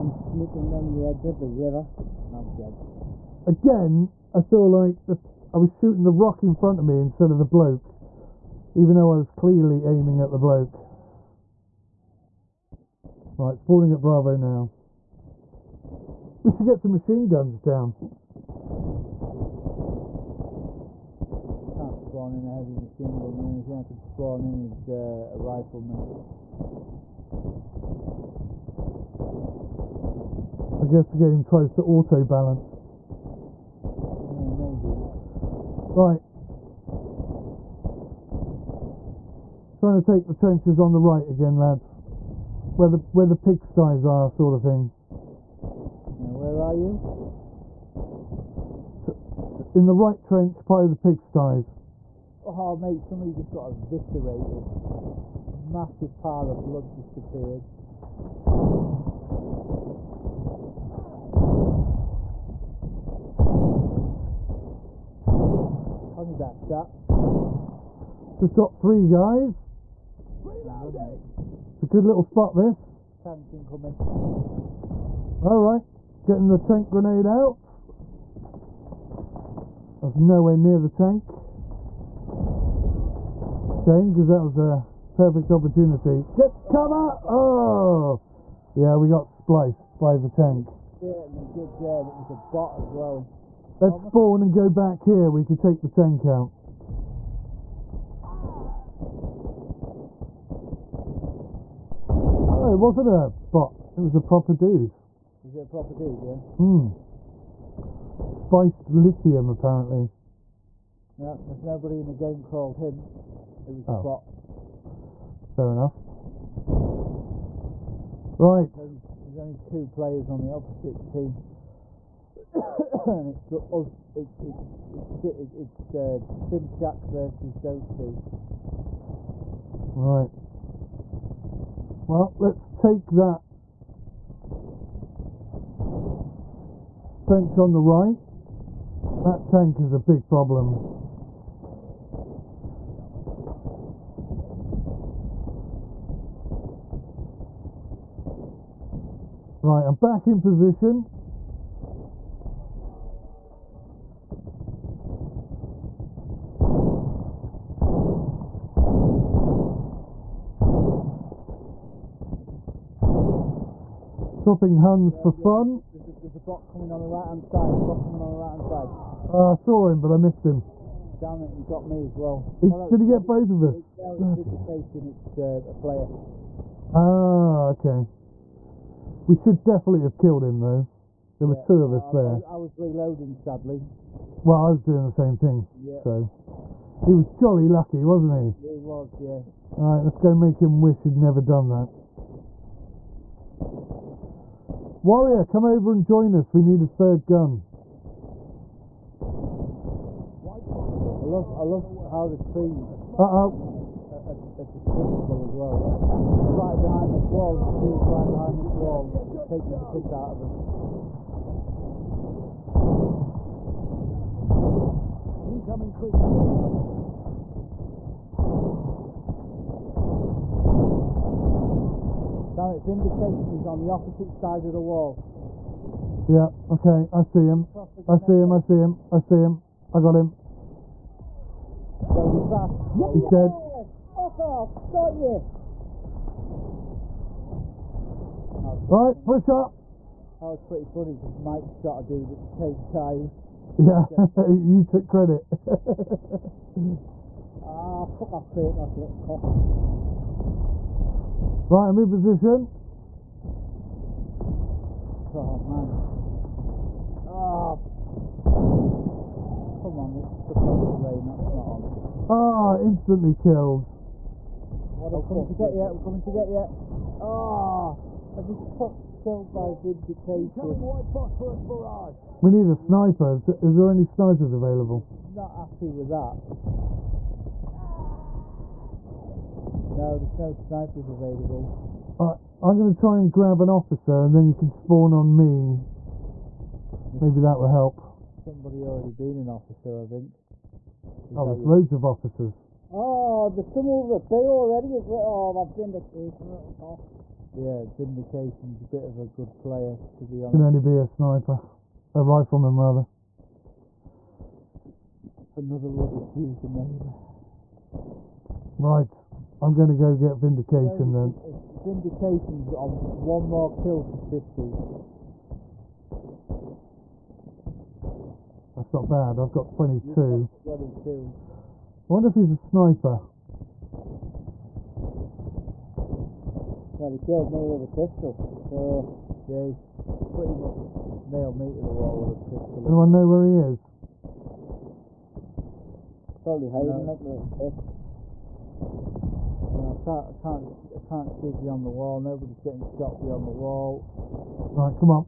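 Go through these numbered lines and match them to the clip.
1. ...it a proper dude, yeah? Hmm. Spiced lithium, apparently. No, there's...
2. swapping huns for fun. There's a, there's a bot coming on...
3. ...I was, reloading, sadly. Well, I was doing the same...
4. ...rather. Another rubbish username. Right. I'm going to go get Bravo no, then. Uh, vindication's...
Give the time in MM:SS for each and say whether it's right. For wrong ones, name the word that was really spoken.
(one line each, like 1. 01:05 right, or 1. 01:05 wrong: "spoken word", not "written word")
1. 01:45 right
2. 02:44 right
3. 03:02 right
4. 05:02 wrong: "Vindication", not "Bravo".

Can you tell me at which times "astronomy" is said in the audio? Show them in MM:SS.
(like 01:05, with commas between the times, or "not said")
not said.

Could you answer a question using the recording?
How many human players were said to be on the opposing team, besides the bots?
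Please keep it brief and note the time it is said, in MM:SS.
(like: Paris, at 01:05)
2, at 01:59.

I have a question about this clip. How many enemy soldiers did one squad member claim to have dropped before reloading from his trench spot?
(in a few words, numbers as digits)
3.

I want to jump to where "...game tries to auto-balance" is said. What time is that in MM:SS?
00:31.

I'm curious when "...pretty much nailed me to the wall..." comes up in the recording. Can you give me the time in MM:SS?
05:30.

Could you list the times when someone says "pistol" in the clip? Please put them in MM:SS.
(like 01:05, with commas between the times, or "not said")
05:27, 05:32.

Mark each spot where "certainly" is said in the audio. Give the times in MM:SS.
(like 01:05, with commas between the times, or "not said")
01:30.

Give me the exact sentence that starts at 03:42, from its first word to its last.
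Damn it, Vindication is on the opposite side of the wall.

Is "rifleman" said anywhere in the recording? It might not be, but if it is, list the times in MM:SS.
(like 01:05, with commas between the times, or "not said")
00:25, 05:02.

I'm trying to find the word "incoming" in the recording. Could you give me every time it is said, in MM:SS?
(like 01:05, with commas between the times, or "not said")
01:13, 03:35.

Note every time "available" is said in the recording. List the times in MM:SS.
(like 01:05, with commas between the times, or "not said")
04:34, 04:41.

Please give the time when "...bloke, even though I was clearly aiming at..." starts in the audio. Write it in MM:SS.
00:07.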